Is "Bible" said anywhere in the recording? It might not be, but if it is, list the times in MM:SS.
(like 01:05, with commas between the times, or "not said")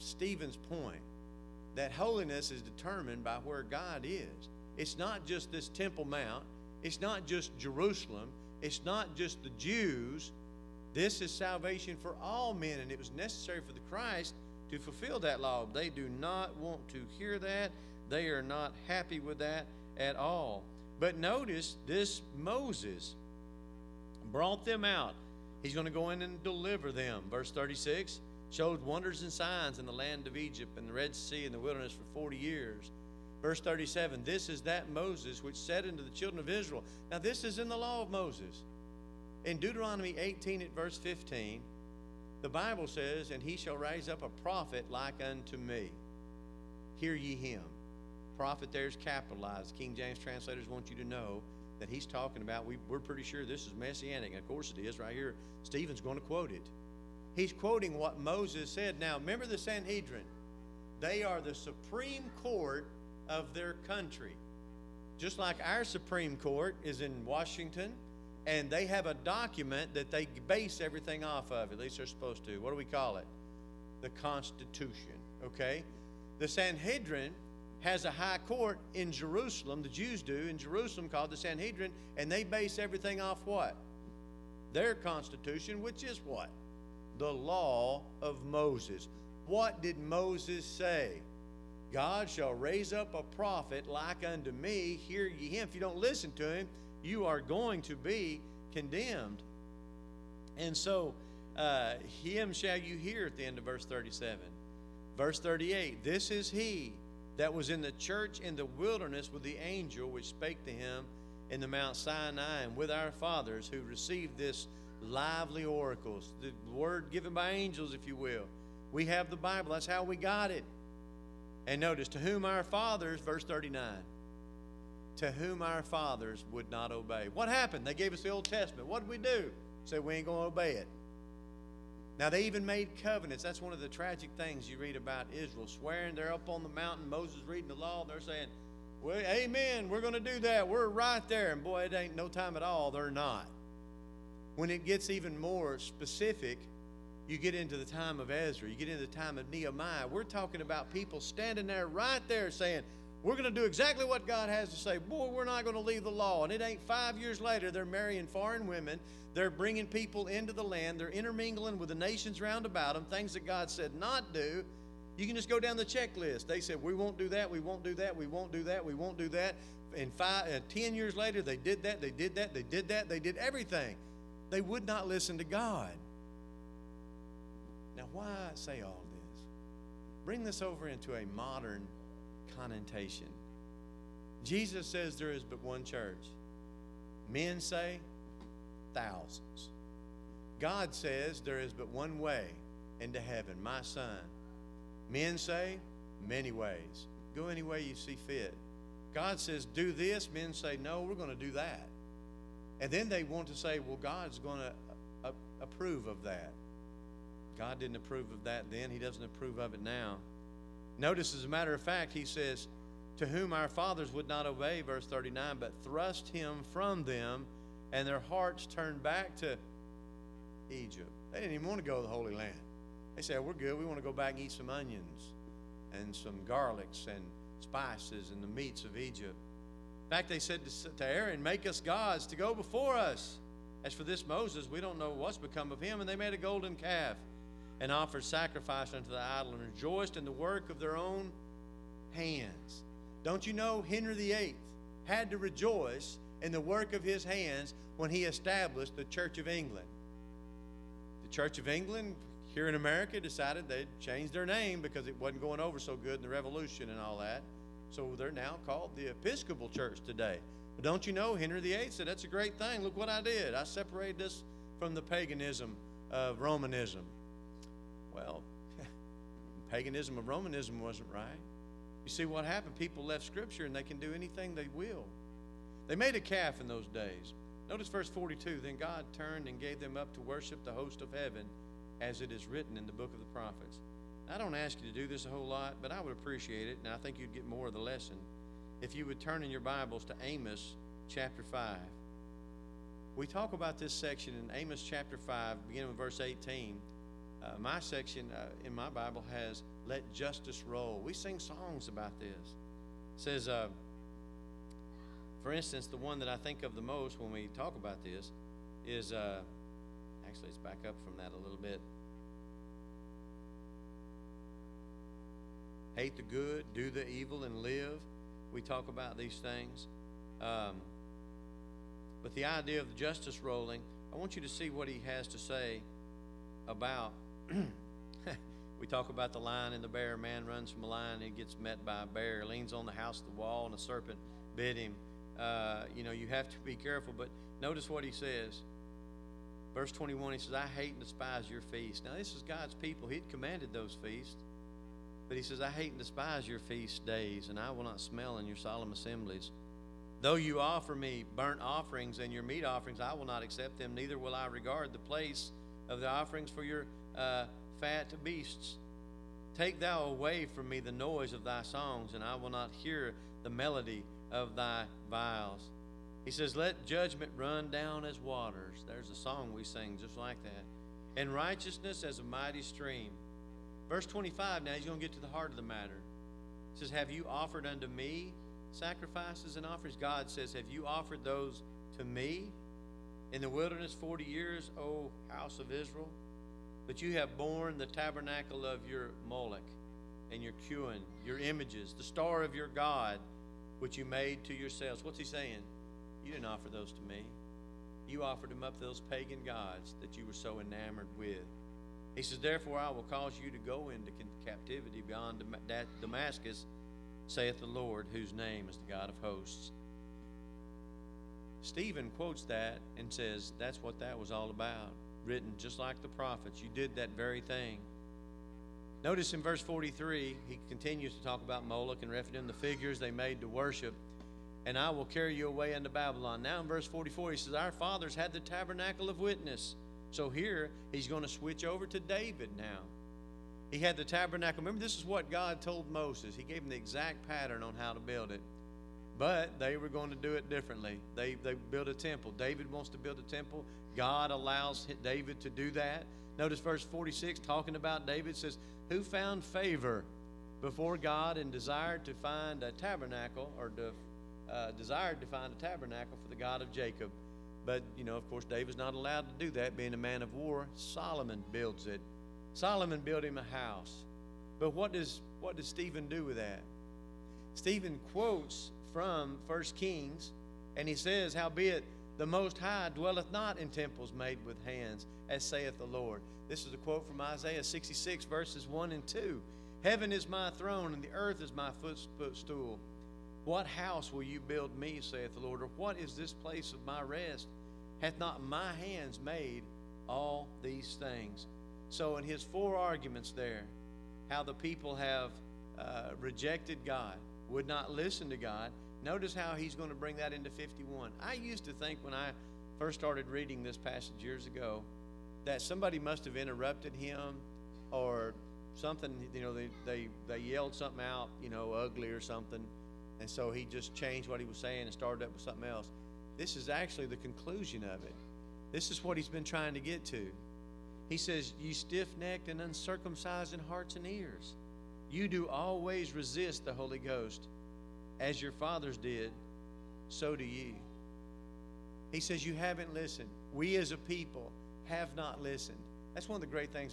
00:42, 01:59, 04:49, 04:58.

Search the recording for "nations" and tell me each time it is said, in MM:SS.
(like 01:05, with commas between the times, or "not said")
02:41.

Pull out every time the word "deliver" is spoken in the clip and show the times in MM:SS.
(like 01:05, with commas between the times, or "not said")
00:26.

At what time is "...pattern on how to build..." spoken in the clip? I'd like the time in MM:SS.
07:17.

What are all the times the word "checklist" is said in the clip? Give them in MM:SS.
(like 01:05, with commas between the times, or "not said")
02:45.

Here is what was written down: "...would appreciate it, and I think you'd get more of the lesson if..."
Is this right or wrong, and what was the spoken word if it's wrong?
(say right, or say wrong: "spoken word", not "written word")
right.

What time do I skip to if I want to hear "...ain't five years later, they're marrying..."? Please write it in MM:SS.
02:36.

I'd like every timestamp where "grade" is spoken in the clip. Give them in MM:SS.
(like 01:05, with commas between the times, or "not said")
not said.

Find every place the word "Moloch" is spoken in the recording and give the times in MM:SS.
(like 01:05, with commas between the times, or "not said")
06:29, 07:01.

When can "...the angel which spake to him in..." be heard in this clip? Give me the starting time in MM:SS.
01:49.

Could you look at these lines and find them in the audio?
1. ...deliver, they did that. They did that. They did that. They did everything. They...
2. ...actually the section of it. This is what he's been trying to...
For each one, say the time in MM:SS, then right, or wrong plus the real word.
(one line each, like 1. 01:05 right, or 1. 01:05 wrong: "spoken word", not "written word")
1. 02:51 wrong: "later", not "deliver"
2. 08:36 wrong: "conclusion", not "section".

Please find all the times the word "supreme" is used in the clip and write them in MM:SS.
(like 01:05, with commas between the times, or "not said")
01:01, 01:05.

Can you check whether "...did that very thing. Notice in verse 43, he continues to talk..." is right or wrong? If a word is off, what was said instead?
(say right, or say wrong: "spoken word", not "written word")
right.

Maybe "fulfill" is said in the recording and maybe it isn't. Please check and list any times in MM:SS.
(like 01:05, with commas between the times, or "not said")
00:14.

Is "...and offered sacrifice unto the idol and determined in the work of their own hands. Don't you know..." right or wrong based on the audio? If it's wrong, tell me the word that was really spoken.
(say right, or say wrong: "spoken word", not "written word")
wrong: "rejoiced", not "determined".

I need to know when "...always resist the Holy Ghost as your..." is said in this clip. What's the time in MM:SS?
08:45.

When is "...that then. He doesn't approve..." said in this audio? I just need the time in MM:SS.
03:28.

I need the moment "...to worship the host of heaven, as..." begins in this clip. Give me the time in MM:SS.
04:40.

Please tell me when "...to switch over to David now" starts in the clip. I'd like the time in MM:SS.
07:11.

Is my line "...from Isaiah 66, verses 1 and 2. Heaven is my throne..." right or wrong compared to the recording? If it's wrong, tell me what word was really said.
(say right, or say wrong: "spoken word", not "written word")
right.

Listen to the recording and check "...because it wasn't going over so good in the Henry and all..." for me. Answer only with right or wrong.
wrong.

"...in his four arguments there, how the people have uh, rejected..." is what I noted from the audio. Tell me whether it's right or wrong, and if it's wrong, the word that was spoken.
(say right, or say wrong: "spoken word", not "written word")
right.